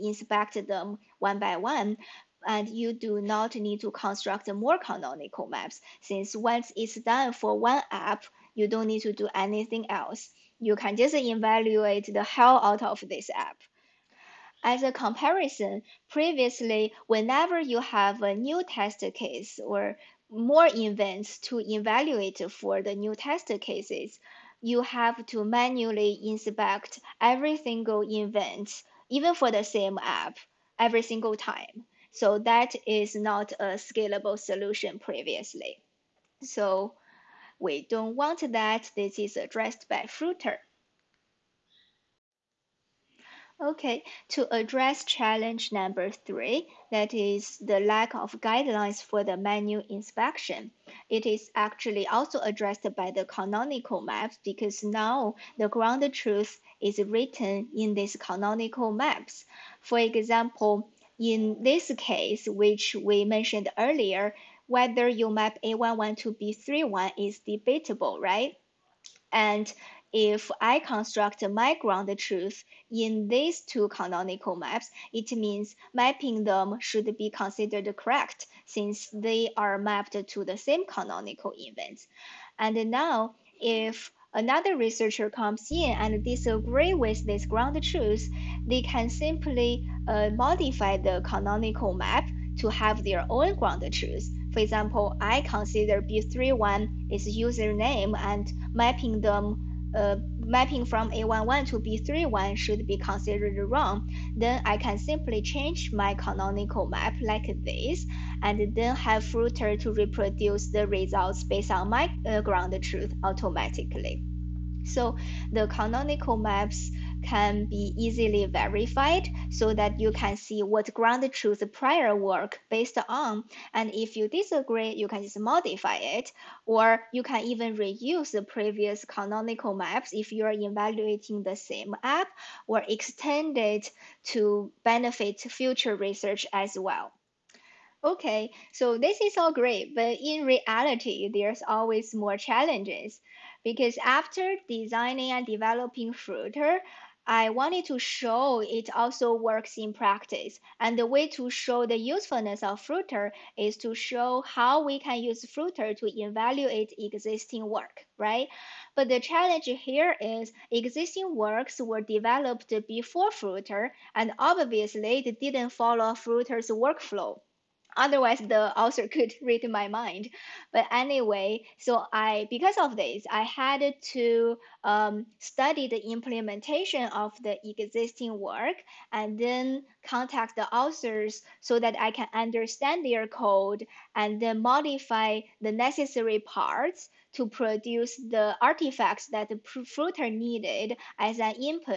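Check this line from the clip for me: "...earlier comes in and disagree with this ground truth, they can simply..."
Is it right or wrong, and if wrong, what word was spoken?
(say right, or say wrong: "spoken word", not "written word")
wrong: "researcher", not "earlier".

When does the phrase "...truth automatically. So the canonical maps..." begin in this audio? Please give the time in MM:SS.
01:52.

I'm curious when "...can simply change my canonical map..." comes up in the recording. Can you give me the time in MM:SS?
01:44.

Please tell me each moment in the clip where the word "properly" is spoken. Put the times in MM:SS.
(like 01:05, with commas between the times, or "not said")
not said.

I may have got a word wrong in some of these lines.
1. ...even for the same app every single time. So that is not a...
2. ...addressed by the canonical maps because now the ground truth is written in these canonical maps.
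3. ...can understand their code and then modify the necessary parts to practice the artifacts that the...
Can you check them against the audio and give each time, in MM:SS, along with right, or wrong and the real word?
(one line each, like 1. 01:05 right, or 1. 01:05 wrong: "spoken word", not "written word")
1. 00:29 right
2. 00:52 right
3. 03:02 wrong: "produce", not "practice".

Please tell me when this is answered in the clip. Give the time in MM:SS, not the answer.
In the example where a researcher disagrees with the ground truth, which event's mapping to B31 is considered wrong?
01:41.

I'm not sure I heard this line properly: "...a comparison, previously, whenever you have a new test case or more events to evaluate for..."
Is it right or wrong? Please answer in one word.
right.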